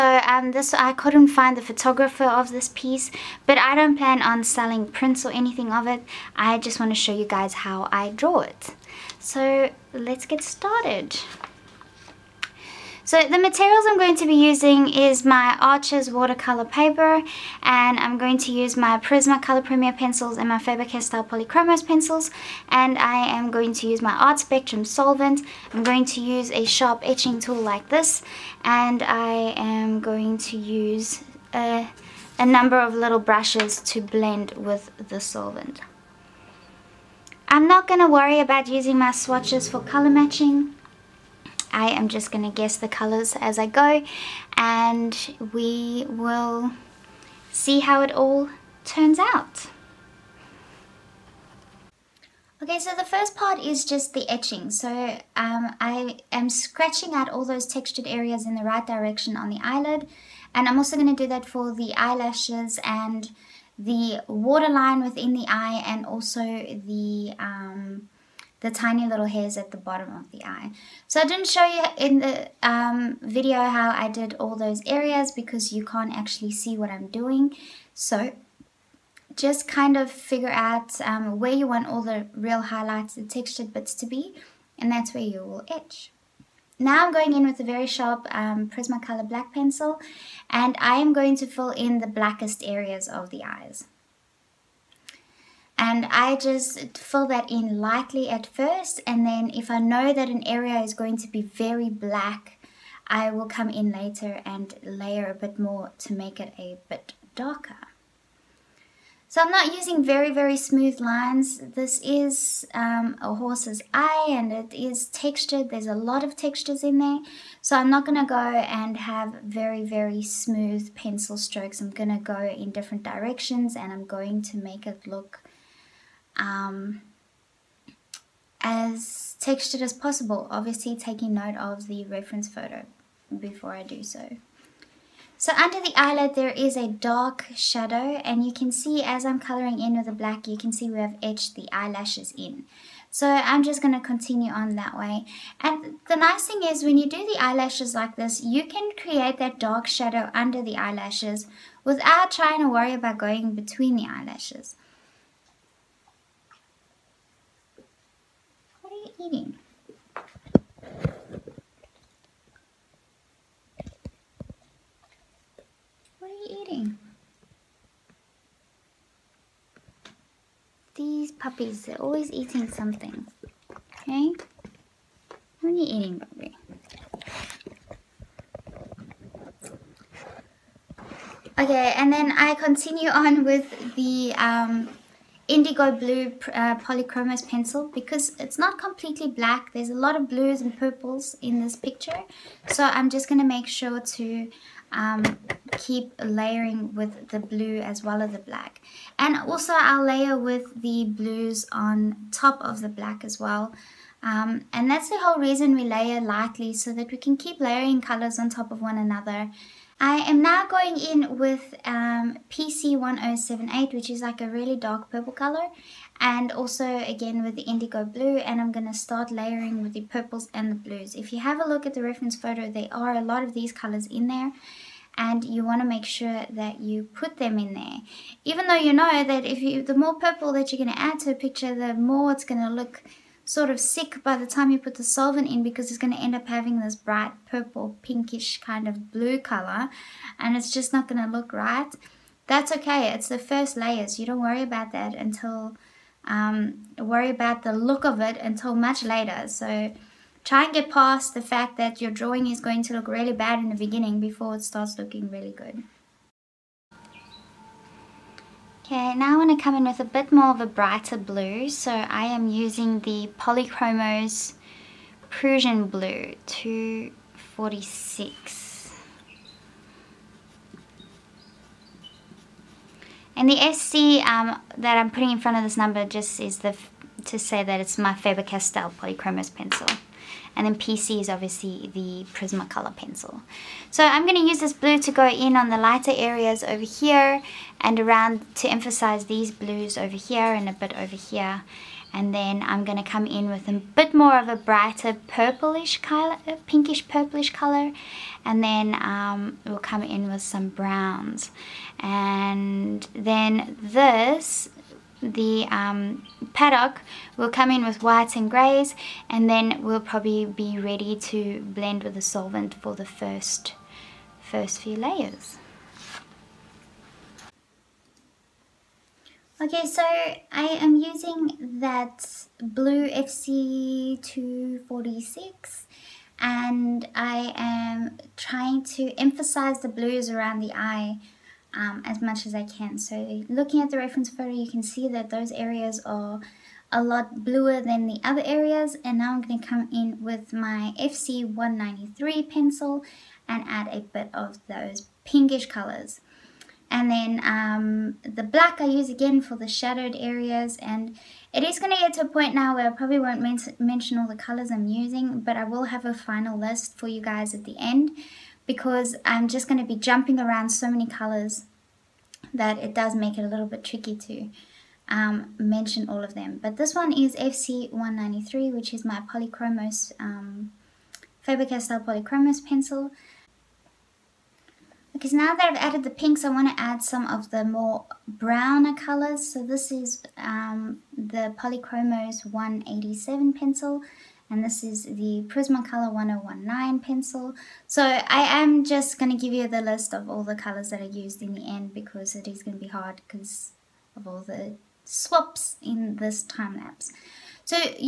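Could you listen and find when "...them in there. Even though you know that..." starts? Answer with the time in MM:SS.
03:47.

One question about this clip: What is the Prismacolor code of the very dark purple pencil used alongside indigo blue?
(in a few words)
PC1078.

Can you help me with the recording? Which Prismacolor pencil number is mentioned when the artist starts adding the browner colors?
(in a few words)
1019.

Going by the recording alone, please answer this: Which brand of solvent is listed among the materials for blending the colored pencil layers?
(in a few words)
Art Spectrum.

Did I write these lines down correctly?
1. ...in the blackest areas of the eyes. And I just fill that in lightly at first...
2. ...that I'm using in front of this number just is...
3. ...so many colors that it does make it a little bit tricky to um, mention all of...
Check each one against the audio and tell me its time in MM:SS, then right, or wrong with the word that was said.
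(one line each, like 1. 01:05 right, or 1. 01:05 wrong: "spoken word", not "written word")
1. 01:31 right
2. 04:34 wrong: "putting", not "using"
3. 06:00 right.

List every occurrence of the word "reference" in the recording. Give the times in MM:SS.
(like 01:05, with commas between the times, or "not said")
02:12, 03:42, 05:33.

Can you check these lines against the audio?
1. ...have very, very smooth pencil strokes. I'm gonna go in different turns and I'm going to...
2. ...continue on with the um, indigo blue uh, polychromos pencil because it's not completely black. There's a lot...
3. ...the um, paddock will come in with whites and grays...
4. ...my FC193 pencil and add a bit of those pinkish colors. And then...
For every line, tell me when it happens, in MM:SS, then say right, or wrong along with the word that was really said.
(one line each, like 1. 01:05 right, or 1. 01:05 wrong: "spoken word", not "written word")
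1. 01:58 wrong: "directions", not "turns"
2. 03:02 right
3. 05:05 right
4. 05:40 right.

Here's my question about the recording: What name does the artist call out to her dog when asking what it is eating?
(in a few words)
Bobby.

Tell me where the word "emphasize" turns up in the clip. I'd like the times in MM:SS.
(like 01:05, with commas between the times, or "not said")
04:48, 05:29.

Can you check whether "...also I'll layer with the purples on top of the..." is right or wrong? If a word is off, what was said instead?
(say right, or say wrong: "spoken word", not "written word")
wrong: "blues", not "purples".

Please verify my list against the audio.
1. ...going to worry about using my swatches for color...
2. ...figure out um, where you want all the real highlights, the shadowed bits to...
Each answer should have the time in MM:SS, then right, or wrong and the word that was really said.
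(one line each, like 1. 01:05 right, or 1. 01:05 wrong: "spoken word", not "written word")
1. 00:37 right
2. 01:20 wrong: "textured", not "shadowed".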